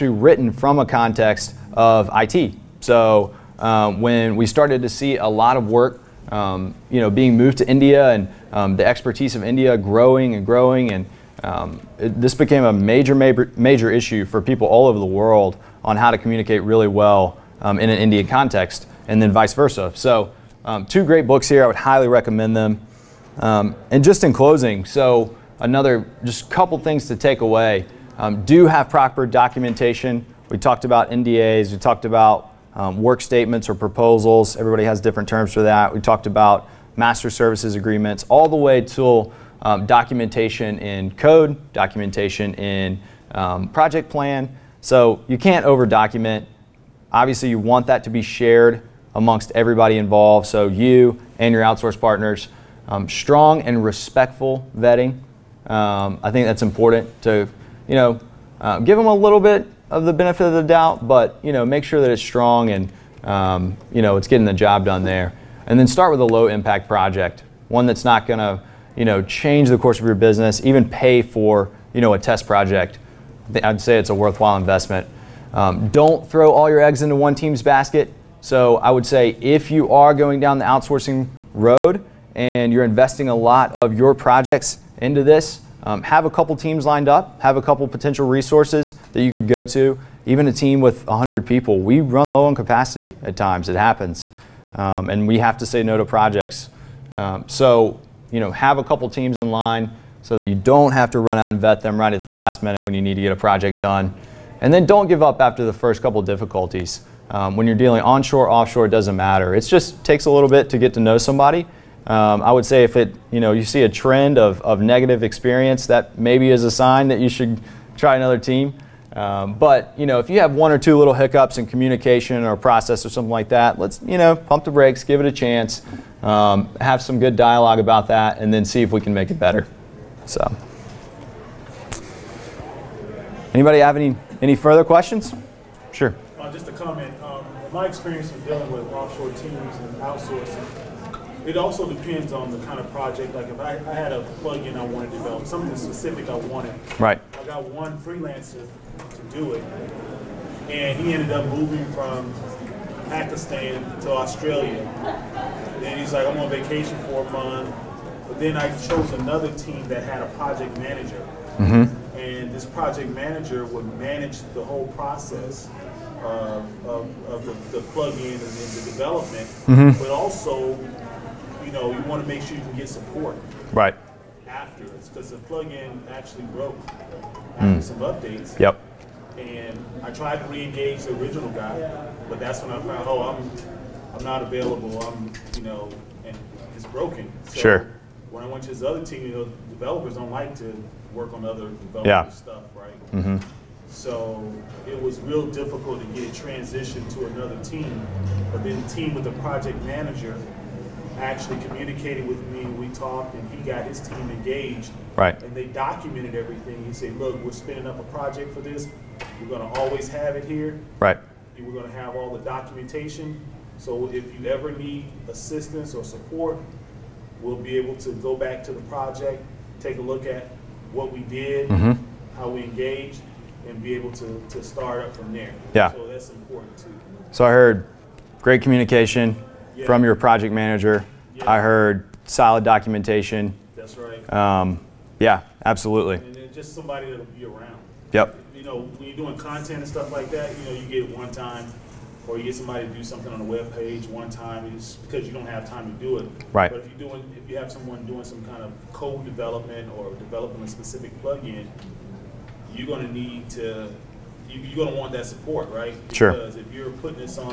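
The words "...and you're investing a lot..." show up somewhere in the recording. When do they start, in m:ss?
1:22.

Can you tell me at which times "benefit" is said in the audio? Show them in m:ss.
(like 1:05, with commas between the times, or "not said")
1:00.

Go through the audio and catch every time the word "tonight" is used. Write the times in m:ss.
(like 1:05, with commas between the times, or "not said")
not said.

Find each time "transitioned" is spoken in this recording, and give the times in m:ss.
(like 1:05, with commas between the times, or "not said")
3:16.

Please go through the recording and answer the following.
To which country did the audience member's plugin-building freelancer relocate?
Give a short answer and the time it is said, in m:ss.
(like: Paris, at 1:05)
Australia, at 2:34.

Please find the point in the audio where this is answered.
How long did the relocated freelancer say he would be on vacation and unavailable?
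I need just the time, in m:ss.
2:37.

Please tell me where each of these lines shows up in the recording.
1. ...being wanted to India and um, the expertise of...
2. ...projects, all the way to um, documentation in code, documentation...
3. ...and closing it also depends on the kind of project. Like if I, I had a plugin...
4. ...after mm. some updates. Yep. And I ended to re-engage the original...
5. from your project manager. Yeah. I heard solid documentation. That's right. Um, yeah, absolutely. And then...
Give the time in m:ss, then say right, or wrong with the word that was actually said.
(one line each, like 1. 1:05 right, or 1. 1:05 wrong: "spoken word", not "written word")
1. 0:07 wrong: "moved", not "wanted"
2. 0:37 wrong: "agreements", not "projects"
3. 2:19 wrong: "outsourcing", not "closing"
4. 2:56 wrong: "tried", not "ended"
5. 3:49 right.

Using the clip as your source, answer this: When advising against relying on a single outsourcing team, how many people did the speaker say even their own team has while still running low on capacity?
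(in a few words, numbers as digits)
100.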